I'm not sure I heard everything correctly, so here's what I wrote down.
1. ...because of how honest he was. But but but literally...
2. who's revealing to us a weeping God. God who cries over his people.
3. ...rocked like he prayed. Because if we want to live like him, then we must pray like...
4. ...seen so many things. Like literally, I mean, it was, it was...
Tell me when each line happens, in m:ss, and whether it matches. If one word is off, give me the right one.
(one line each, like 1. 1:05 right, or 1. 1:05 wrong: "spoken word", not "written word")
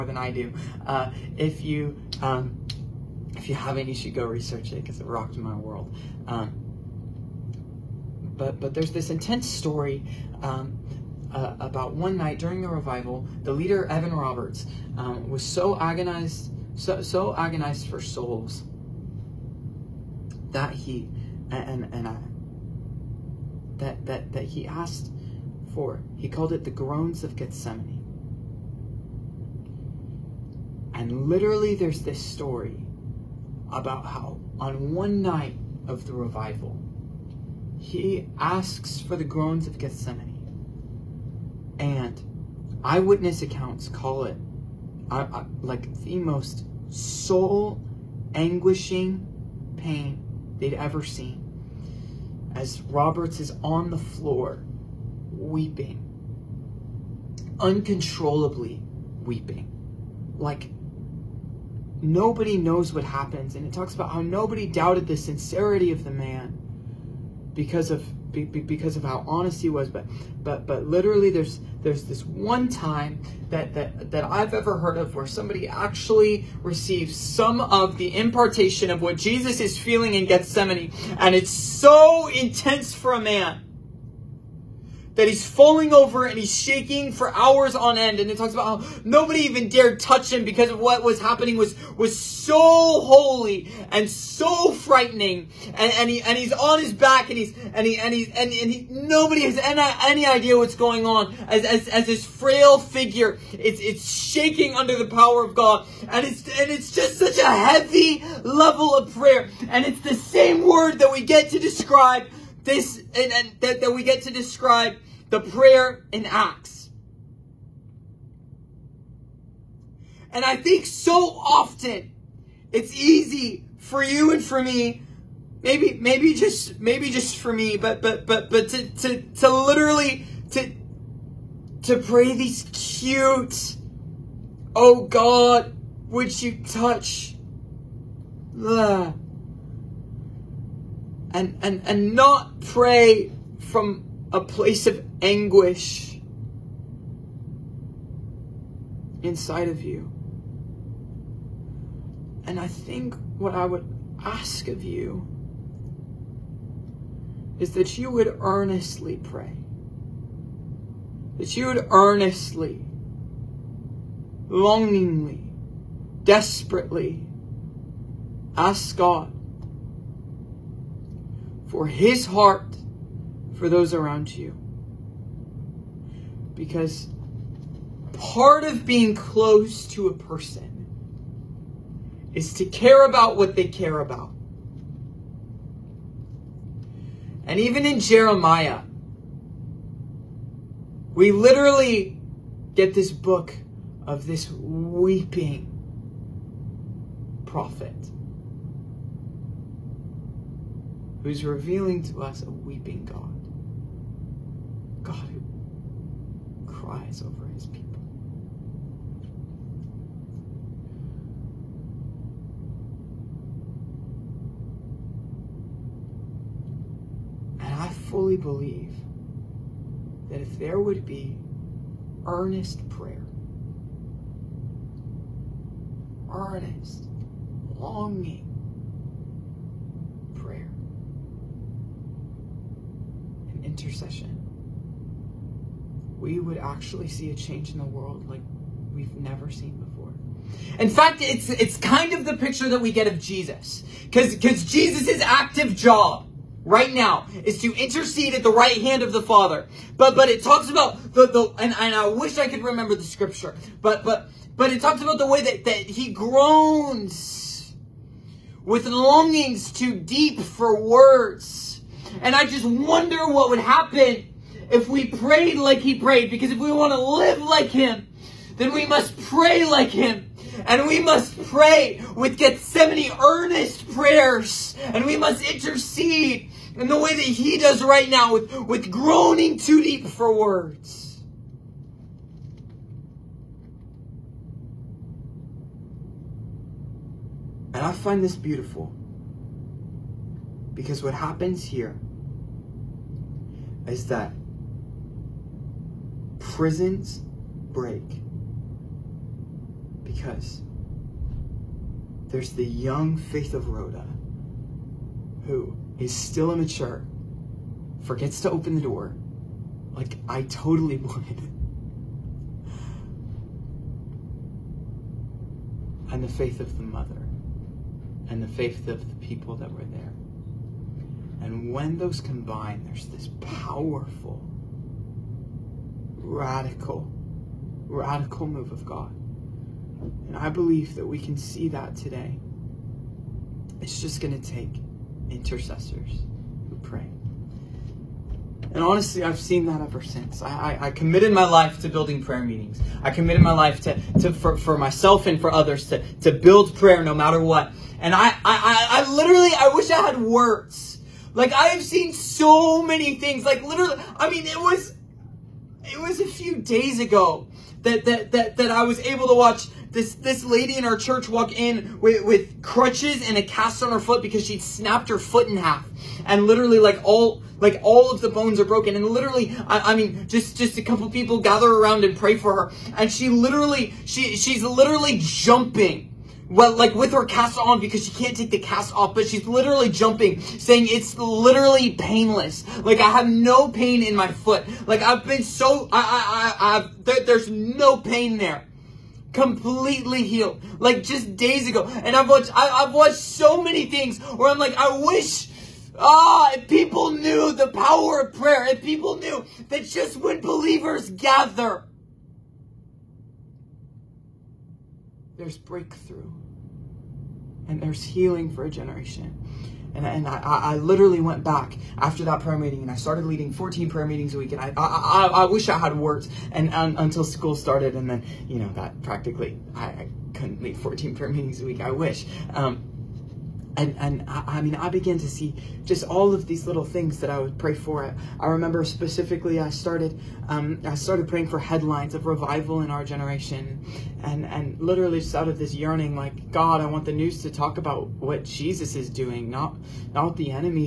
1. 1:08 right
2. 3:21 right
3. 4:25 wrong: "prayed", not "rocked"
4. 5:51 right.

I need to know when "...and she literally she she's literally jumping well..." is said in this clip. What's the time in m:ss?
6:12.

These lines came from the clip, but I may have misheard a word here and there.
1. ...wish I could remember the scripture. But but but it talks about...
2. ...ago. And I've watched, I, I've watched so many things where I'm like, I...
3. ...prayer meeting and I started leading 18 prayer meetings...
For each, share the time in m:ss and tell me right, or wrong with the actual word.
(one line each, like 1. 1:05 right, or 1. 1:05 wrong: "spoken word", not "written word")
1. 4:12 right
2. 6:31 right
3. 6:52 wrong: "14", not "18".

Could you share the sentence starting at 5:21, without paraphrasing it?
And when those combine, there's this powerful, radical, radical move of God.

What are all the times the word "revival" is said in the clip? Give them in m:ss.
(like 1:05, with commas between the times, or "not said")
0:12, 0:36, 7:12.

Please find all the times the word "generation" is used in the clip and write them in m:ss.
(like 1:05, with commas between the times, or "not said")
6:48, 7:13.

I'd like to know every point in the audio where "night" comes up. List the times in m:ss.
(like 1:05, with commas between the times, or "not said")
0:12, 0:35.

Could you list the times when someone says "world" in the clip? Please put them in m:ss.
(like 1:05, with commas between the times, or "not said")
0:05, 3:57.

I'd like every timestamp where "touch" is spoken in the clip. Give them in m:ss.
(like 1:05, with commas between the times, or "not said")
1:29, 2:16.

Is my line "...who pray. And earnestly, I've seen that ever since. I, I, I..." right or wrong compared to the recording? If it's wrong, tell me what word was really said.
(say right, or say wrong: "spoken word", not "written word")
wrong: "honestly", not "earnestly".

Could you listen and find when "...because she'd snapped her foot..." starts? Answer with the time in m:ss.
6:04.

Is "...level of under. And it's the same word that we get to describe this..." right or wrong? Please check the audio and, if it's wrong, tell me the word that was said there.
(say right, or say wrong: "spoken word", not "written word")
wrong: "prayer", not "under".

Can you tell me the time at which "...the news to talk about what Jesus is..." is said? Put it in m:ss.
7:17.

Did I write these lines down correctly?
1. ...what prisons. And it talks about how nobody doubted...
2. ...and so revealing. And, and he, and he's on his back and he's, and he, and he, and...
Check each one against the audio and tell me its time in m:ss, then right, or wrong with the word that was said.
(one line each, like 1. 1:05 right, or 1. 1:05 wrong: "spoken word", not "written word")
1. 1:02 wrong: "happens", not "prisons"
2. 1:33 wrong: "frightening", not "revealing".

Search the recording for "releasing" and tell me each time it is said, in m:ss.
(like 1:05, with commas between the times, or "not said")
not said.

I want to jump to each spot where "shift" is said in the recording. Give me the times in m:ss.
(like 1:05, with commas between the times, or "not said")
not said.